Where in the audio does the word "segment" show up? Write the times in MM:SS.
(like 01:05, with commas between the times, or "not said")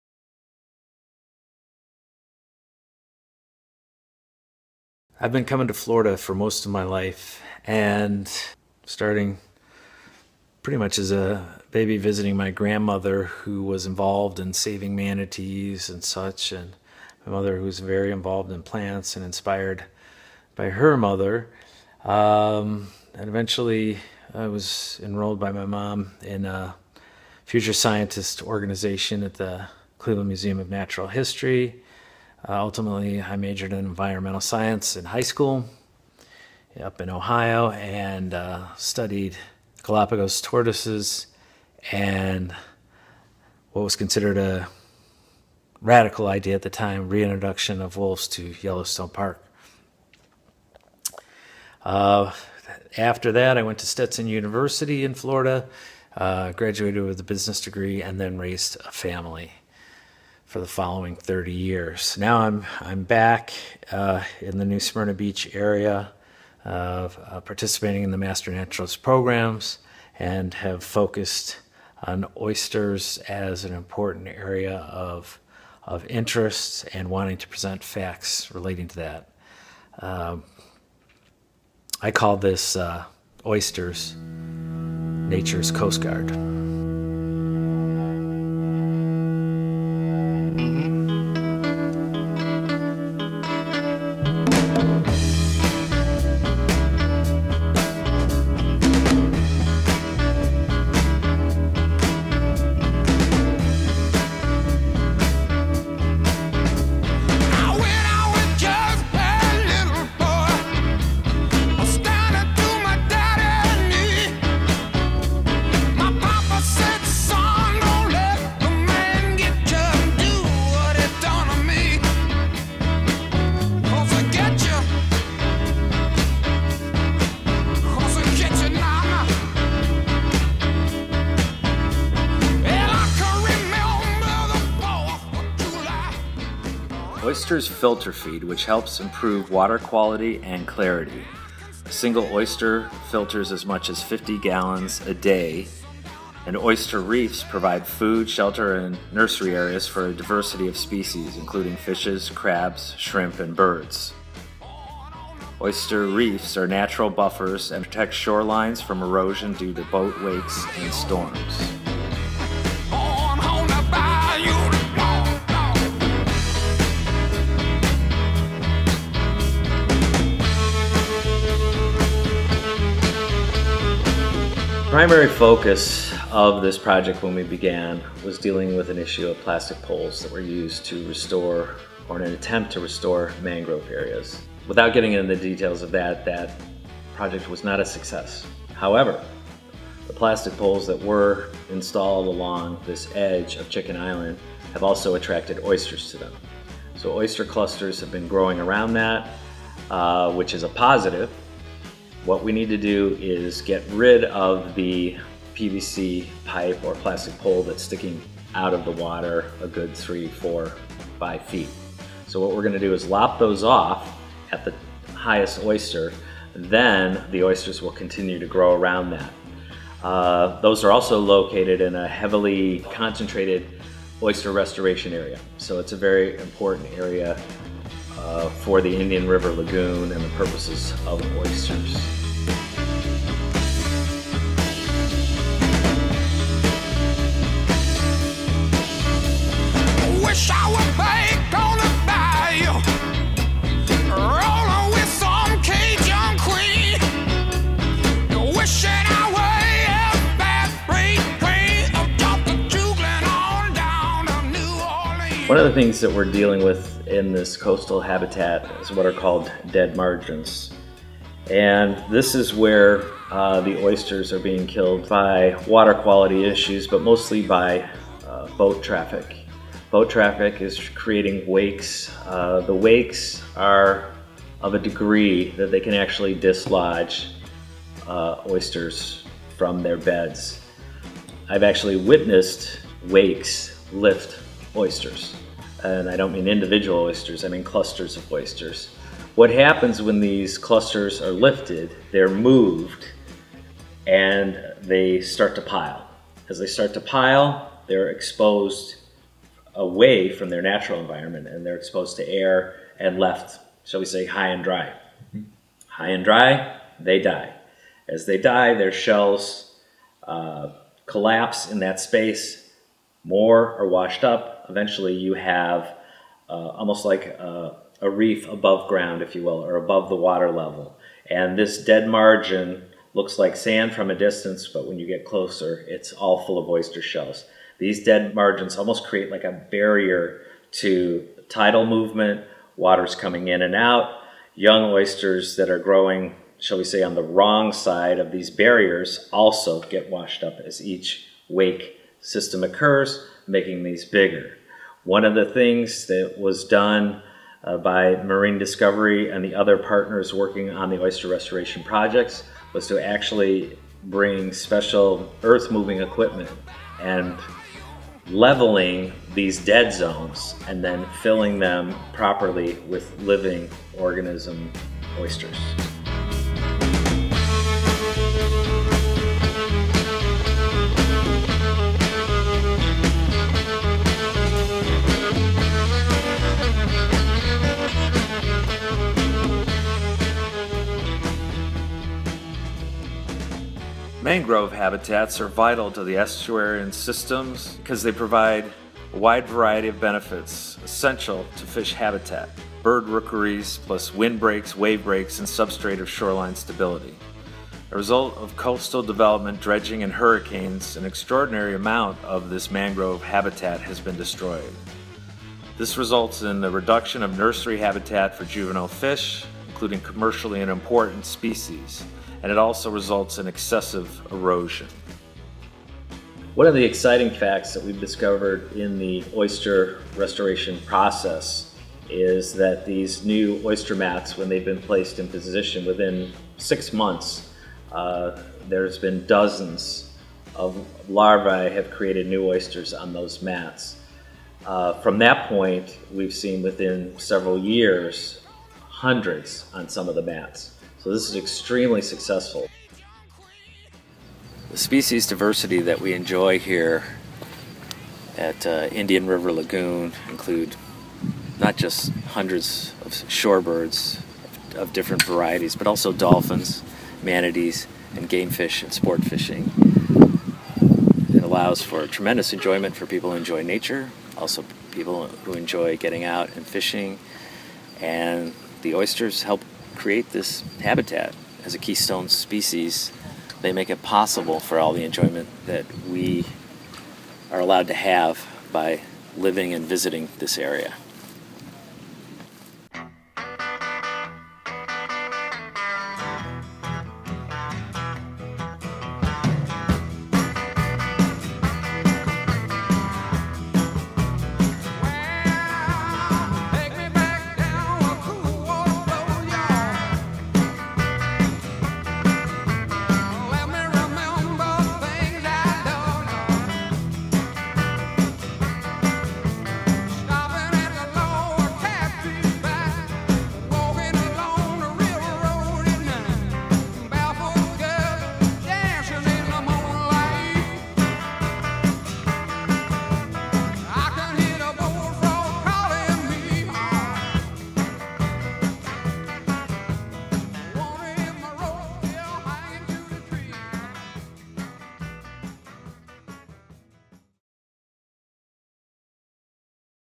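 not said.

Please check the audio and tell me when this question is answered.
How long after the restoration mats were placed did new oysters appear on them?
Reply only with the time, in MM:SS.
07:06.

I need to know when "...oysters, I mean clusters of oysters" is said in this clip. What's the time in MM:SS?
04:46.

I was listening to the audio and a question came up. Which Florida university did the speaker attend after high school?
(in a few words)
Stetson University.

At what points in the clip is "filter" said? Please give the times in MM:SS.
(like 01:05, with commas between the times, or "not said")
02:17, 02:23.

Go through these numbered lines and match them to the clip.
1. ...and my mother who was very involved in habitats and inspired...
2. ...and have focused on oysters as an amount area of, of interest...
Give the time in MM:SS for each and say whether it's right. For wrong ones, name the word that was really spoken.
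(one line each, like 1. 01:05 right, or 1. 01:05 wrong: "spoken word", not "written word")
1. 00:16 wrong: "plants", not "habitats"
2. 01:10 wrong: "important", not "amount".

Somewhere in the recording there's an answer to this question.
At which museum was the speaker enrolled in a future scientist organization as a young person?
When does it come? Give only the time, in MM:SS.
00:29.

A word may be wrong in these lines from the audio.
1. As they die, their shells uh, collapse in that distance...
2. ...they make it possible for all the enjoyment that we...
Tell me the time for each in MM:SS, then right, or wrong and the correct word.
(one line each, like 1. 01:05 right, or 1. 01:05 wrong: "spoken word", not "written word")
1. 05:08 wrong: "space", not "distance"
2. 07:53 right.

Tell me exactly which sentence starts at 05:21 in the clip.
And this dead margin looks like sand from a distance, but when you get closer, it's all full of oyster shells.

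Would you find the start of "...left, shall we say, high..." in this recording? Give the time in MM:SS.
05:03.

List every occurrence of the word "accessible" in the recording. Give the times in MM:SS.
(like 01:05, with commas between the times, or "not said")
not said.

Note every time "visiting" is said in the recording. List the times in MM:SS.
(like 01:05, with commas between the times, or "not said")
00:11, 07:59.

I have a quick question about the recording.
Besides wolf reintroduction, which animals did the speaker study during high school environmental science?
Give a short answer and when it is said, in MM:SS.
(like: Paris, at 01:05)
Galapagos tortoises, at 00:39.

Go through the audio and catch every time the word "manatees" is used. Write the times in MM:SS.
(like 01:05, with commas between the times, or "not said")
00:14, 07:37.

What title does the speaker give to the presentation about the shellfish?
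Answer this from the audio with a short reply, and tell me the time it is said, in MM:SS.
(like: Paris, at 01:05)
Oysters Nature's Coast Guard, at 01:23.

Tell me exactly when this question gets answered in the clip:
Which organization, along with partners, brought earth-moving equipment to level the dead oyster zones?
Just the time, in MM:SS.
05:48.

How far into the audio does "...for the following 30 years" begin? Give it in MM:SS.
01:00.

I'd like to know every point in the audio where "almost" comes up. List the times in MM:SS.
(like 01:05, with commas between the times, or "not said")
05:16, 05:28.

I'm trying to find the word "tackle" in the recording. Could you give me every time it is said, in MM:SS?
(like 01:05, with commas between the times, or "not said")
not said.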